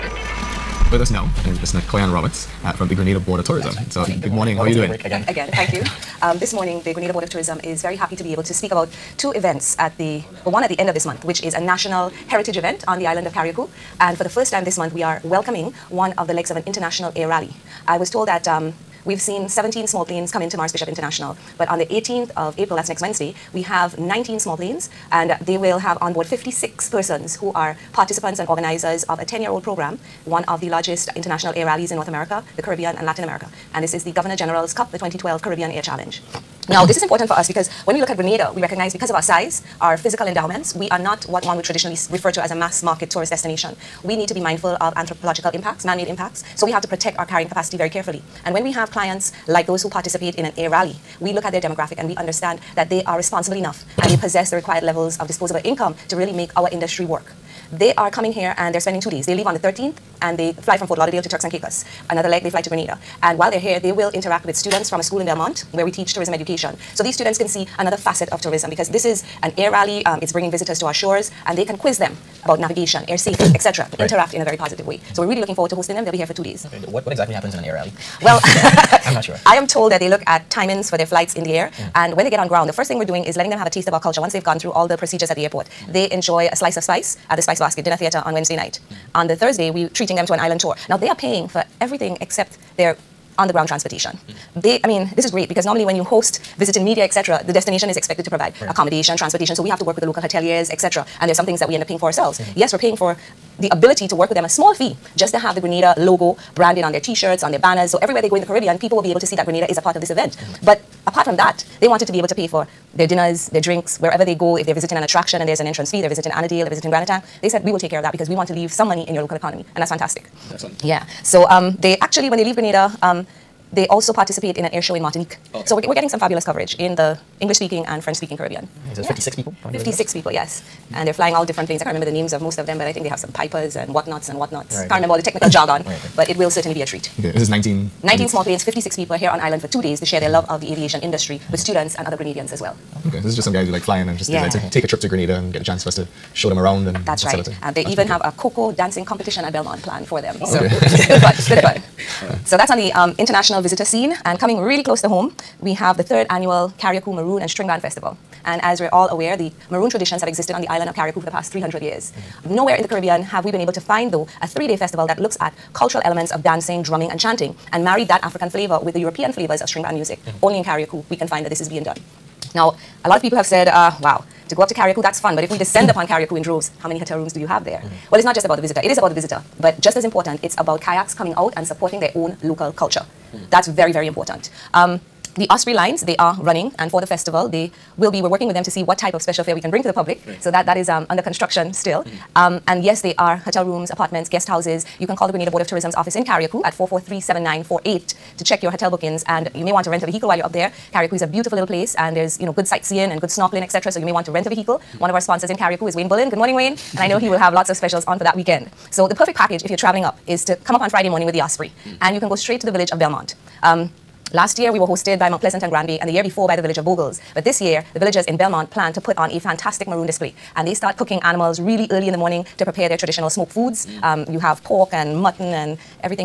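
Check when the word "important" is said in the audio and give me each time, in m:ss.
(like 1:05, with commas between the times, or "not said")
0:37, 3:00, 3:04.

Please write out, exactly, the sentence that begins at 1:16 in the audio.
They'll be here for two days.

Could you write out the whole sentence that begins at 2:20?
love of the aviation industry with mm-hmm.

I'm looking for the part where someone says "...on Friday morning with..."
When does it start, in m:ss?
3:30.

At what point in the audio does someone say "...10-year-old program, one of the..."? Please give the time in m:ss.
0:29.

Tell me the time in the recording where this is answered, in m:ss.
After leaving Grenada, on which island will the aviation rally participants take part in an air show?
2:05.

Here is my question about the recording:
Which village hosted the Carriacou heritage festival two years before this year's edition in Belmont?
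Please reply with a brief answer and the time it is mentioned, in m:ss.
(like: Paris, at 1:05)
Bogles, at 3:36.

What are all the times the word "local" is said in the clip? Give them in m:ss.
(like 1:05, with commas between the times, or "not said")
1:40, 1:59, 3:02.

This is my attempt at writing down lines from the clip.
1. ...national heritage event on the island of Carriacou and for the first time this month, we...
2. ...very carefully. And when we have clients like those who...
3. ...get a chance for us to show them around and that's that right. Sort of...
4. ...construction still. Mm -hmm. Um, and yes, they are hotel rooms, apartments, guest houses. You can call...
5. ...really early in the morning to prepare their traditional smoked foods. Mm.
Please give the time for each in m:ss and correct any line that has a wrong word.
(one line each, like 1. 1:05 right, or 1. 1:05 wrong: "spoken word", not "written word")
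1. 0:11 right
2. 0:47 right
3. 2:25 right
4. 3:11 right
5. 3:41 right.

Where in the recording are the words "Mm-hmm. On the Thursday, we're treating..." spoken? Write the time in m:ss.
1:28.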